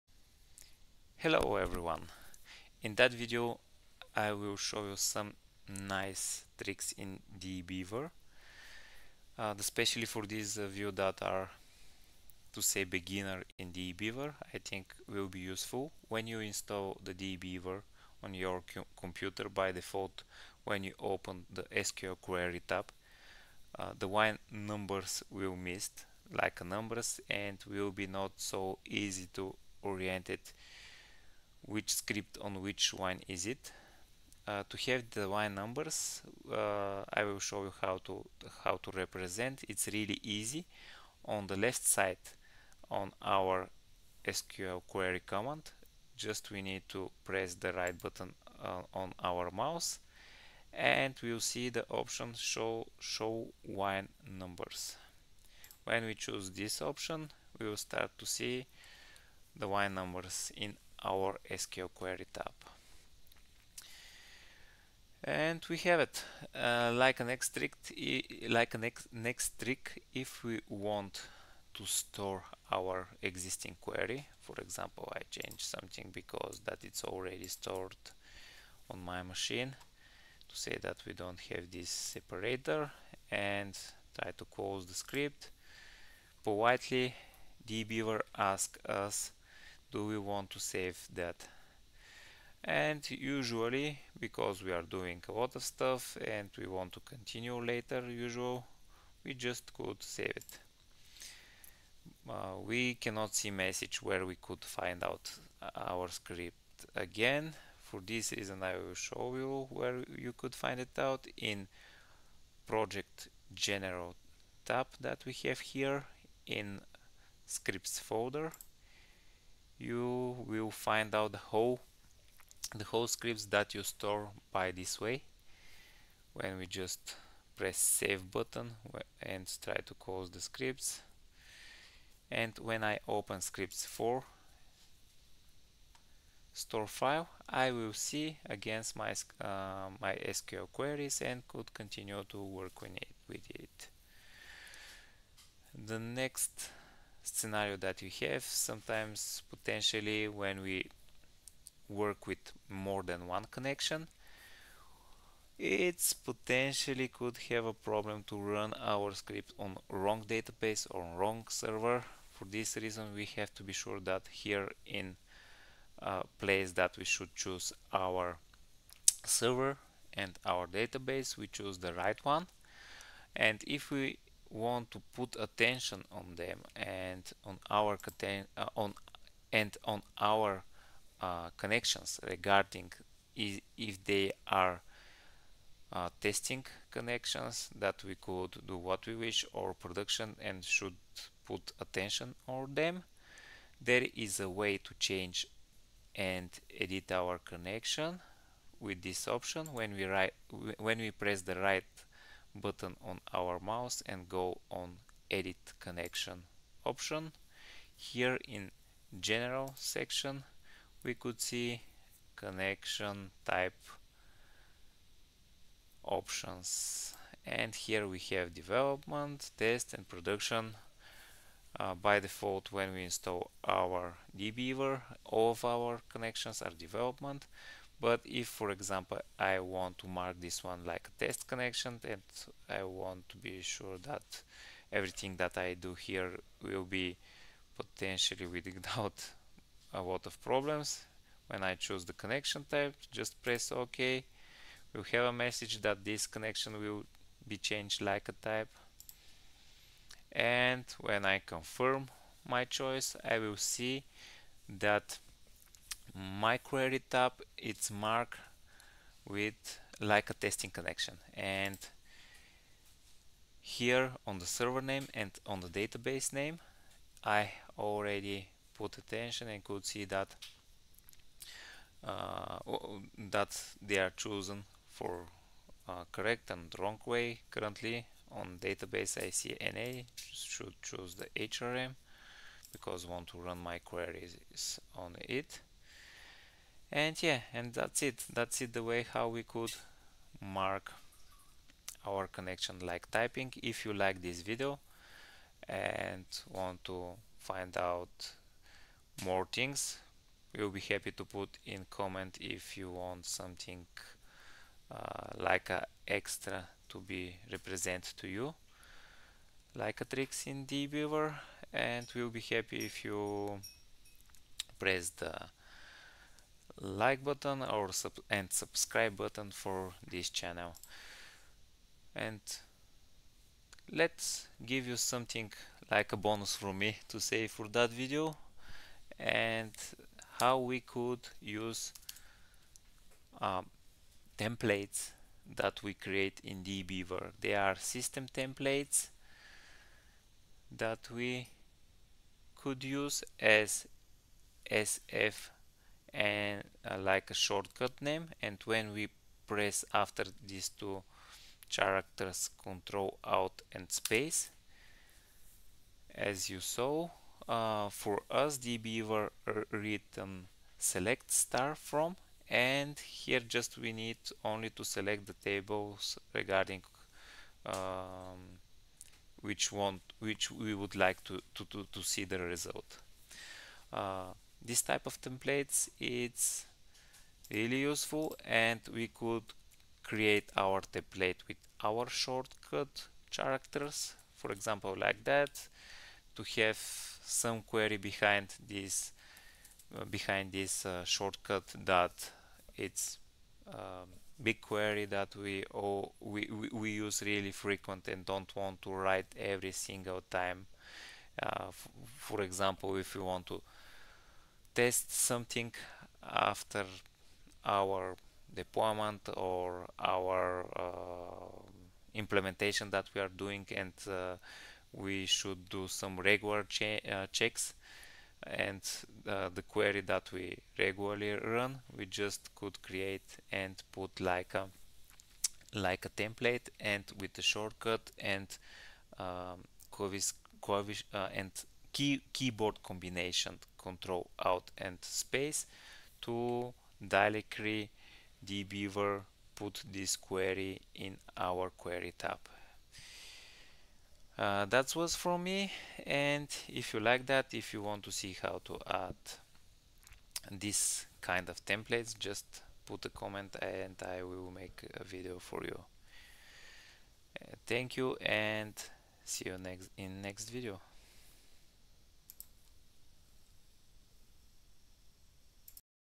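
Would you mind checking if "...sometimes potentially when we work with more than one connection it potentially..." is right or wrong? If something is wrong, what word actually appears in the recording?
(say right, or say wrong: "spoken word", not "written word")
right.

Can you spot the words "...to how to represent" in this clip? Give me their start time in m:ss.
0:38.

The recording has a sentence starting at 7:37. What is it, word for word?
Uh, thank you and see you next in next video.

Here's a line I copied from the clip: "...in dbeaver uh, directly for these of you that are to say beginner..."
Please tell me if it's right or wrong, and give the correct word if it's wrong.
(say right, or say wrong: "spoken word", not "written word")
wrong: "especially", not "directly".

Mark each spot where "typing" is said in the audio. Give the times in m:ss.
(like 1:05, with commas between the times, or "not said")
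4:53.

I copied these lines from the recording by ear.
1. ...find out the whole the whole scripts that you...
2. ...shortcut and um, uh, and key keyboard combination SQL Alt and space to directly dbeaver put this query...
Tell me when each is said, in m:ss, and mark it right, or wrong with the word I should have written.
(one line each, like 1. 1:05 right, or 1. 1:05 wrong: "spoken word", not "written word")
1. 2:00 right
2. 7:07 wrong: "Control", not "SQL".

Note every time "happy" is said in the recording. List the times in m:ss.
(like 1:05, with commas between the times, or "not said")
5:00, 5:12.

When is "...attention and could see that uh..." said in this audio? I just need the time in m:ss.
4:28.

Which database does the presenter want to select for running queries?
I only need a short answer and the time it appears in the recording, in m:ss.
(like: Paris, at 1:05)
HRM, at 4:41.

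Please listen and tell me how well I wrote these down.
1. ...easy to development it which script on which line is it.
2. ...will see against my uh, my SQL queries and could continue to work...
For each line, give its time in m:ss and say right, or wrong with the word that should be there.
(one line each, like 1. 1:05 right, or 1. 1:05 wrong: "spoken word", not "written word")
1. 0:28 wrong: "orient", not "development"
2. 2:17 right.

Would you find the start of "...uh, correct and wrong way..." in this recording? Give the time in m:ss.
4:35.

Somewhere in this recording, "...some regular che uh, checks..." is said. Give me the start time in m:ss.
6:55.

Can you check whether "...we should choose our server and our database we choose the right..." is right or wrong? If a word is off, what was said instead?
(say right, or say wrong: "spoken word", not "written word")
right.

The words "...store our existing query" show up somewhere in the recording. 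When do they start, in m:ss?
1:11.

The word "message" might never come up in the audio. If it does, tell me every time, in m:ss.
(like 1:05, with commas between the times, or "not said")
1:43, 4:05.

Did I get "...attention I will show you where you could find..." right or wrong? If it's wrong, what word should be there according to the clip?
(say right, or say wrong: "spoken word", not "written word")
wrong: "reason", not "attention".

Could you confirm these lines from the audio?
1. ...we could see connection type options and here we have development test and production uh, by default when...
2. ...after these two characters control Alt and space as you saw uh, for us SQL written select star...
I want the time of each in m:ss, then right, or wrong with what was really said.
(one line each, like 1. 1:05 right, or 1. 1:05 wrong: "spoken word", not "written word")
1. 3:31 right
2. 5:49 wrong: "DBeaver", not "SQL".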